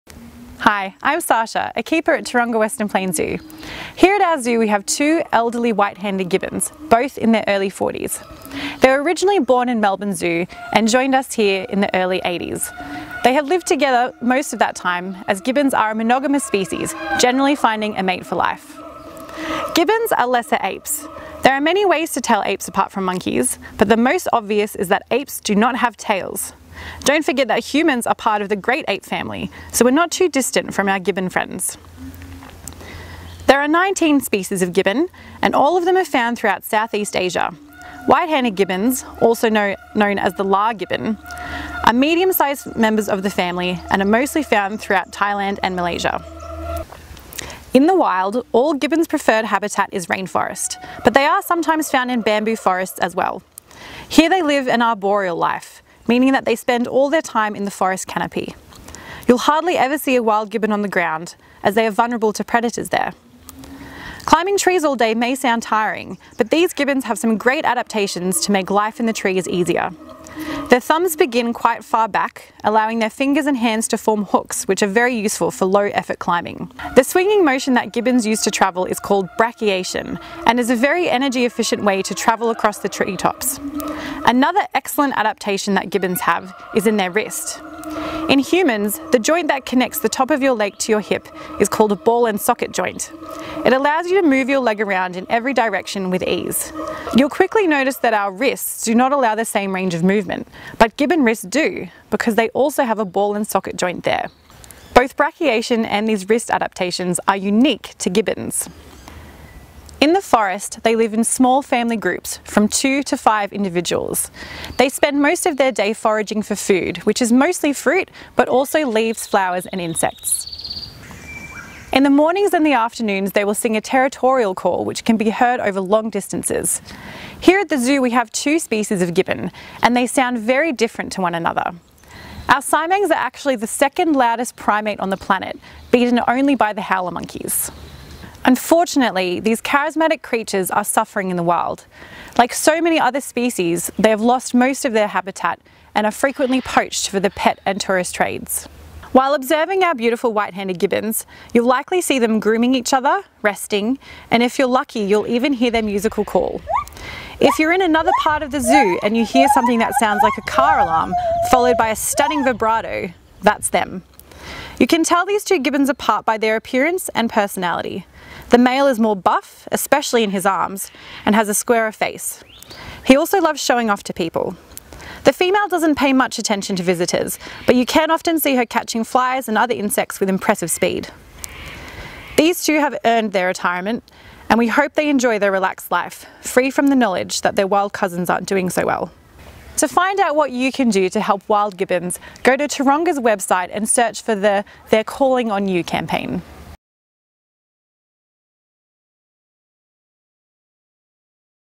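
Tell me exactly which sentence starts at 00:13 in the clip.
They have lived together most of that time as gibbons are a monogamous species, generally finding a mate for life.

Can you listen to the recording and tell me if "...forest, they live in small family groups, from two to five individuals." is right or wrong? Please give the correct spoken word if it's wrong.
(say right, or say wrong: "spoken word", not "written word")
right.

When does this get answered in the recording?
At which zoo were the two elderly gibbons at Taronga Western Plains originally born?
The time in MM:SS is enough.
00:09.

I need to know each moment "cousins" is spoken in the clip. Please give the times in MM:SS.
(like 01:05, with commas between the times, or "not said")
03:07.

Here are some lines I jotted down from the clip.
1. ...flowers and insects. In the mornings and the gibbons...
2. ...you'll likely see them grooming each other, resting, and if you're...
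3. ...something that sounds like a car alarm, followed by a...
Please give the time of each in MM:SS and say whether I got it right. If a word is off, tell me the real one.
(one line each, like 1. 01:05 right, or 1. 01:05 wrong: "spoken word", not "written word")
1. 01:59 wrong: "afternoons", not "gibbons"
2. 02:31 right
3. 02:39 right.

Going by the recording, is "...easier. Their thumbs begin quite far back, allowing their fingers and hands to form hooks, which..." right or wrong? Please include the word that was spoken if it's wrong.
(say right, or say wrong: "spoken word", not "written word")
right.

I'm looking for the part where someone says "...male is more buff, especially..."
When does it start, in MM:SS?
02:48.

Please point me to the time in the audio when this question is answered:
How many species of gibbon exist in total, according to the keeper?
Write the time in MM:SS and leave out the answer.
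00:33.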